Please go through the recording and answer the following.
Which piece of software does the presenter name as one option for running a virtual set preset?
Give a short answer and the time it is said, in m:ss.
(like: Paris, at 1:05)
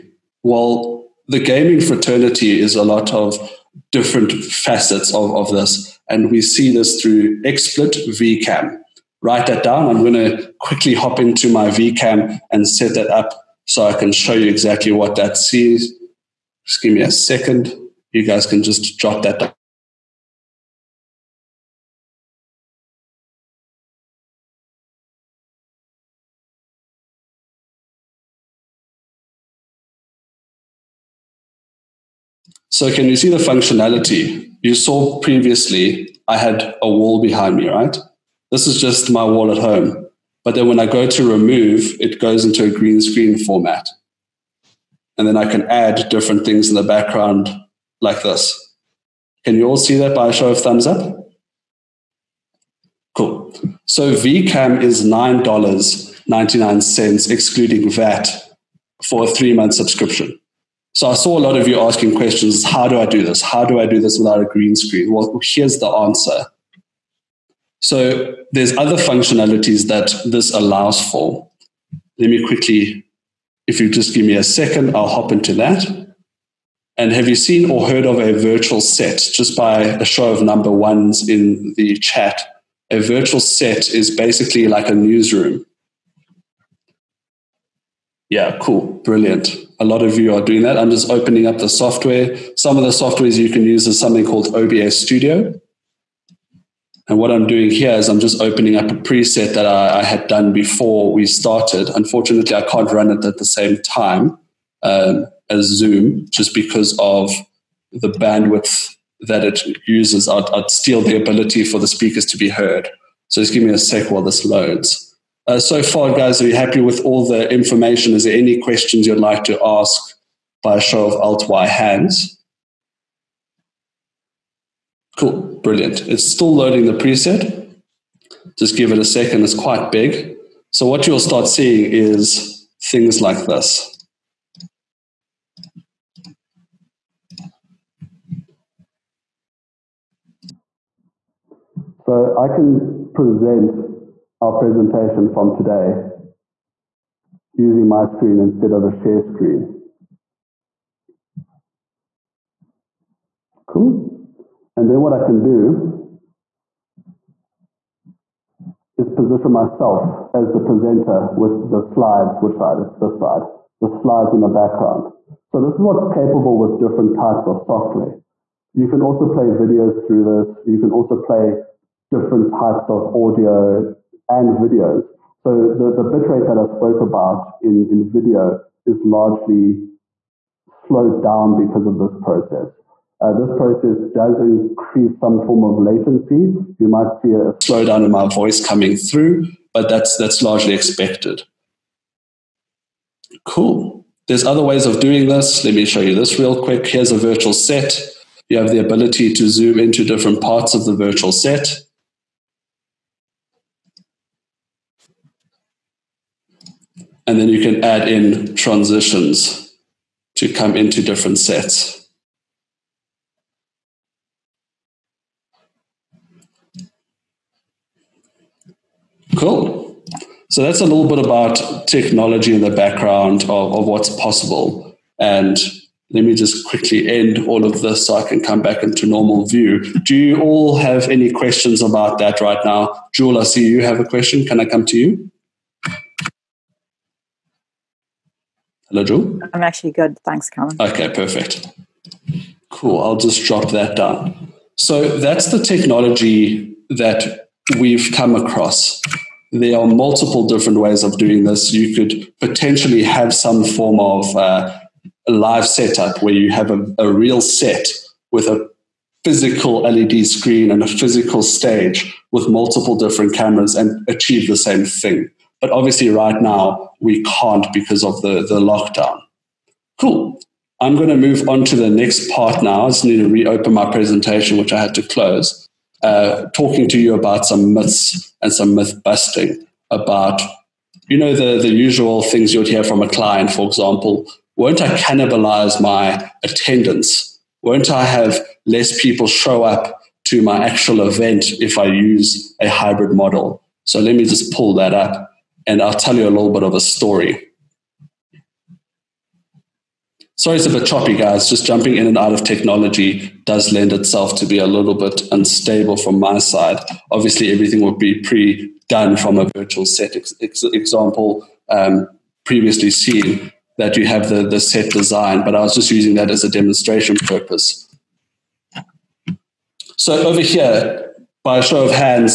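OBS Studio, at 1:34.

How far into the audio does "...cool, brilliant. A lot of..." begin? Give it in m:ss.
1:28.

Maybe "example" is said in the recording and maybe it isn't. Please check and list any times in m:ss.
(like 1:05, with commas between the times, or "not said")
4:43, 5:10.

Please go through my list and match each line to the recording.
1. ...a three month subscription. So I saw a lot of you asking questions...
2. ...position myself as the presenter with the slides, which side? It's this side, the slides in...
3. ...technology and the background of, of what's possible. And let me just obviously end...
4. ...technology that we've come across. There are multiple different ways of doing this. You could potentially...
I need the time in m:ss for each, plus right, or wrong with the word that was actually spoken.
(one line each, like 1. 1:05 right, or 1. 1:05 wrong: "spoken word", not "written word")
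1. 0:59 right
2. 2:39 right
3. 3:41 wrong: "quickly", not "obviously"
4. 4:05 right.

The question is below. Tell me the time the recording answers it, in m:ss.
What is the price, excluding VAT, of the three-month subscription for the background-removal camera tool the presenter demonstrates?
0:55.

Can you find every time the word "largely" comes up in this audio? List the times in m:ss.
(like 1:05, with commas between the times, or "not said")
2:59, 3:10.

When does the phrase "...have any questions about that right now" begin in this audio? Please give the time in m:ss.
3:50.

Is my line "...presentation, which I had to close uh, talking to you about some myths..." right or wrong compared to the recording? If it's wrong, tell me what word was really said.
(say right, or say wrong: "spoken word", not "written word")
right.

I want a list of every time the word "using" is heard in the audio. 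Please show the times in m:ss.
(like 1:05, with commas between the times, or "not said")
2:27, 5:15.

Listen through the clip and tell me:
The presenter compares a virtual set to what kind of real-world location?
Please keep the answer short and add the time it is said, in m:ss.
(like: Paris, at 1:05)
A newsroom, at 1:24.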